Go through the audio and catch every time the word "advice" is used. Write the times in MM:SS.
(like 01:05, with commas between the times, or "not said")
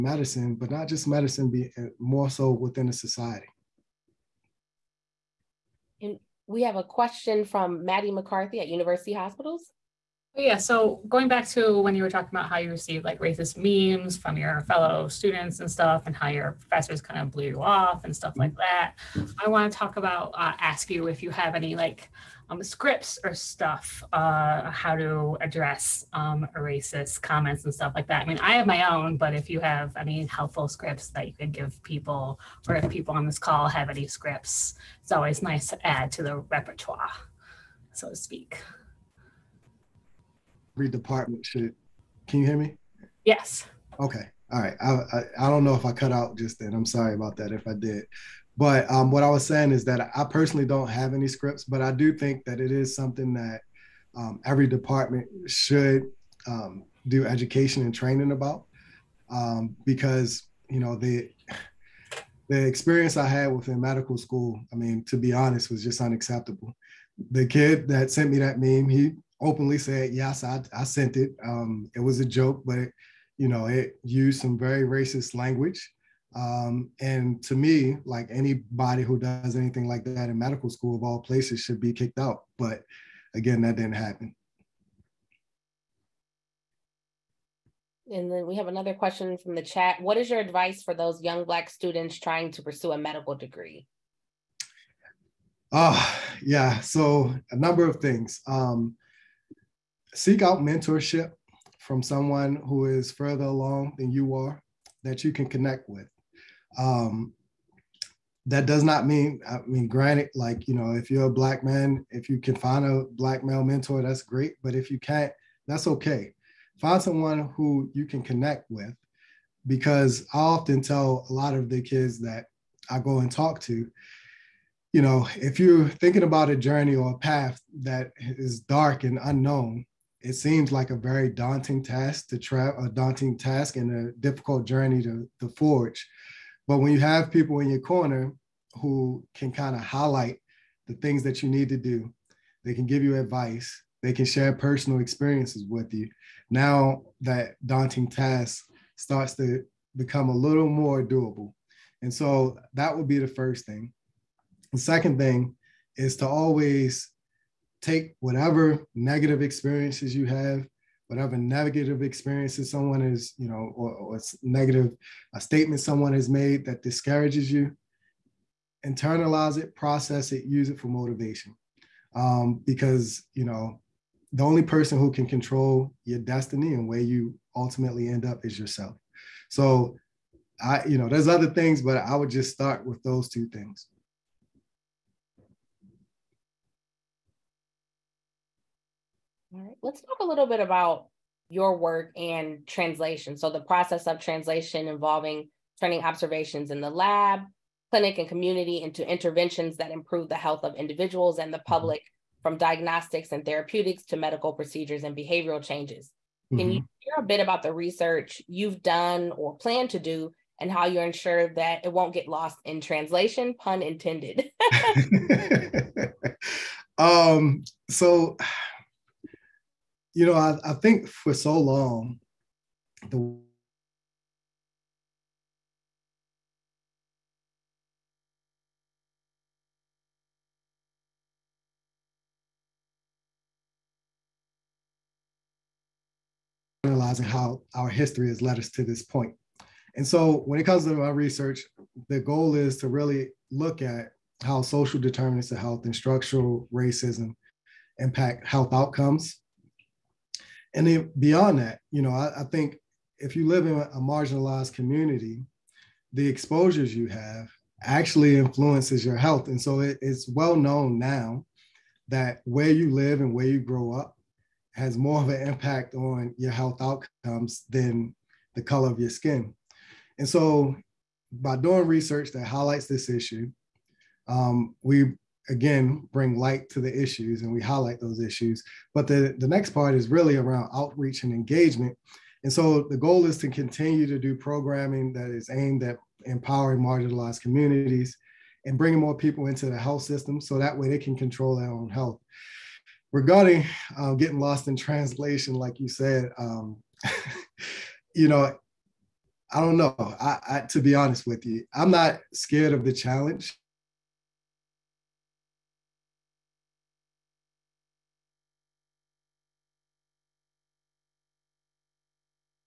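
01:30, 02:23.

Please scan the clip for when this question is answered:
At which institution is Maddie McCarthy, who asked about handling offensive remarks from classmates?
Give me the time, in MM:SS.
00:08.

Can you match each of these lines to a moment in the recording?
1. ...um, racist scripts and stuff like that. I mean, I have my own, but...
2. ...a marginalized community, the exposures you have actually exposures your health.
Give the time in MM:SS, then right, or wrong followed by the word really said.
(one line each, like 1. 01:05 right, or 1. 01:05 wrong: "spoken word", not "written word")
1. 00:26 wrong: "comments", not "scripts"
2. 04:13 wrong: "influences", not "exposures".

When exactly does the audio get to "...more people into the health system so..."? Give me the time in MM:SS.
04:48.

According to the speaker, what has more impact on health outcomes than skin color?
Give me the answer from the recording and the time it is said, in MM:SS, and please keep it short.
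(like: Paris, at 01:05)
Where you live, at 04:22.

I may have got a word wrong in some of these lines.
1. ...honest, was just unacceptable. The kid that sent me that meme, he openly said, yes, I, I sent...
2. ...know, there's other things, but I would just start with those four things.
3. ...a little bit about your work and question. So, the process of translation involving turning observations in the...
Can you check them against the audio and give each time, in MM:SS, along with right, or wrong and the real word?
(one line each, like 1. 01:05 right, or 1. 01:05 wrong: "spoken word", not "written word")
1. 01:05 right
2. 03:00 wrong: "two", not "four"
3. 03:10 wrong: "translation", not "question".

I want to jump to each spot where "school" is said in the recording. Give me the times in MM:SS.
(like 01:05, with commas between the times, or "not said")
01:04, 01:20.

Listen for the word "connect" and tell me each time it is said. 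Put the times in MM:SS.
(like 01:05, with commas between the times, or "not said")
01:45, 01:58.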